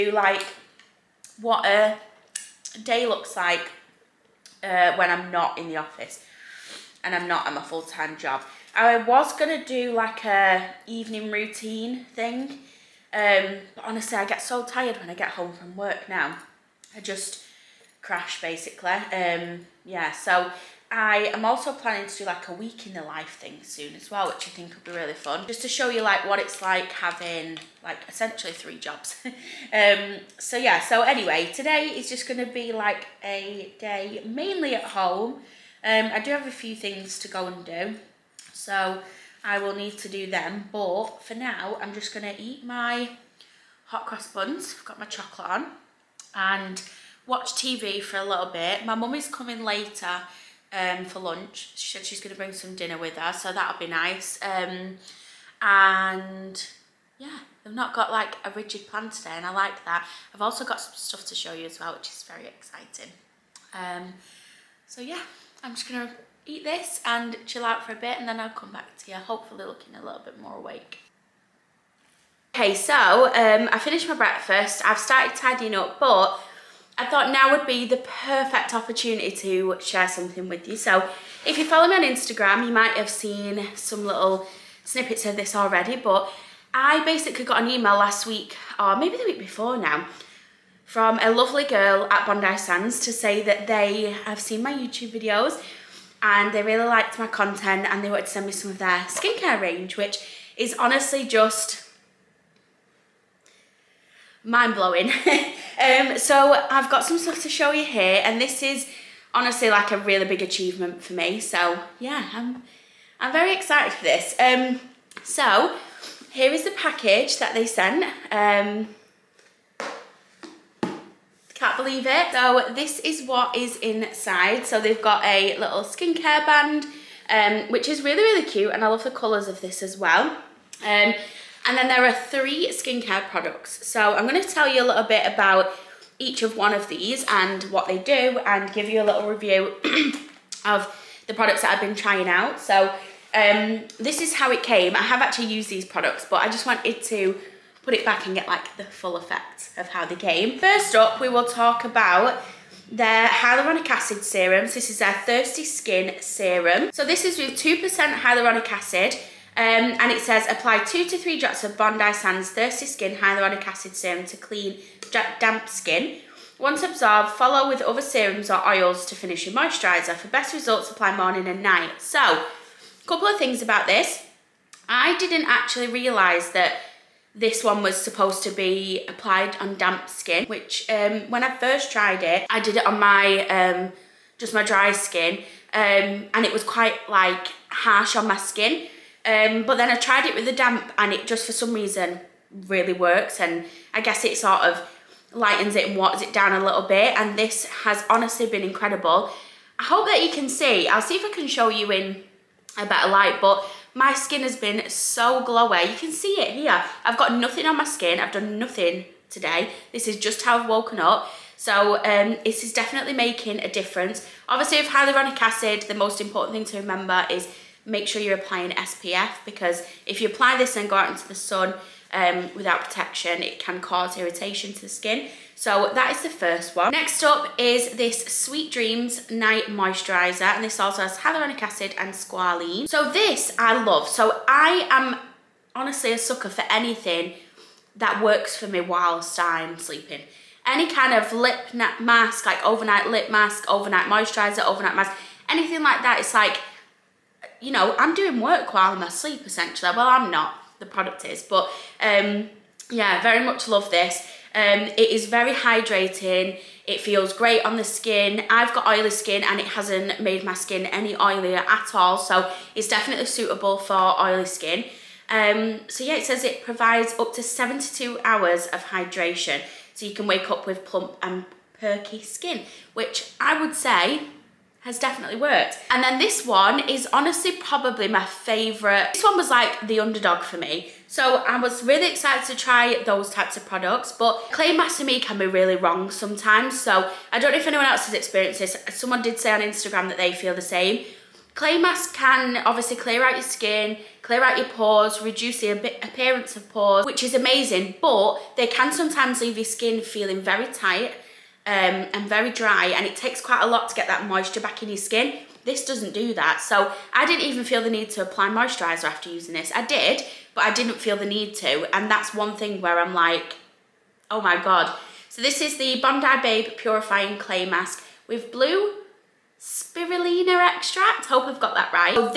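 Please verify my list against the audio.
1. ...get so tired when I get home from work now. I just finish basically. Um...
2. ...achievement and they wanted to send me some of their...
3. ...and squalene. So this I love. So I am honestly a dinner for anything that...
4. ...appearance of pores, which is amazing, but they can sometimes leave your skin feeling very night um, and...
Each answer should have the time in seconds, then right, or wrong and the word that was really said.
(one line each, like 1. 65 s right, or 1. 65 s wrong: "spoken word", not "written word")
1. 14 s wrong: "crash", not "finish"
2. 97 s wrong: "content", not "achievement"
3. 231 s wrong: "sucker", not "dinner"
4. 296 s wrong: "tight", not "night".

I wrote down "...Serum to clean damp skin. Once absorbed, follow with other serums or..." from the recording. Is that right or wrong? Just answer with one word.
right.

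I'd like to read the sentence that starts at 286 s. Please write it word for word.
So I don't know if anyone else has experienced this.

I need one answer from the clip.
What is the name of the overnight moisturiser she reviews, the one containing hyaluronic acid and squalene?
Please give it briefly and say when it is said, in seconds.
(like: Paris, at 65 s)
Sweet Dreams, at 228 s.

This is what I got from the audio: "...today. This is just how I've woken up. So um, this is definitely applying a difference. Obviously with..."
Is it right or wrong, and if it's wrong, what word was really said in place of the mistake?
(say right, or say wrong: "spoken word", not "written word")
wrong: "making", not "applying".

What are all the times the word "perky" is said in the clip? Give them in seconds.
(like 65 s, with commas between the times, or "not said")
271 s.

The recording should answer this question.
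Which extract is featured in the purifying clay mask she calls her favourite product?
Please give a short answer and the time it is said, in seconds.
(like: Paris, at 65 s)
Blue spirulina, at 318 s.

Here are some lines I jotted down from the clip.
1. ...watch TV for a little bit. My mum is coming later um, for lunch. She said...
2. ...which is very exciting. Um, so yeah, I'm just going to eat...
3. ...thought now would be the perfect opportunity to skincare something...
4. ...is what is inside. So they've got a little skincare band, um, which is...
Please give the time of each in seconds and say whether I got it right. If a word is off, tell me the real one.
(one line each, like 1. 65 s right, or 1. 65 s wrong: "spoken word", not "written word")
1. 47 s right
2. 61 s right
3. 77 s wrong: "share", not "skincare"
4. 122 s right.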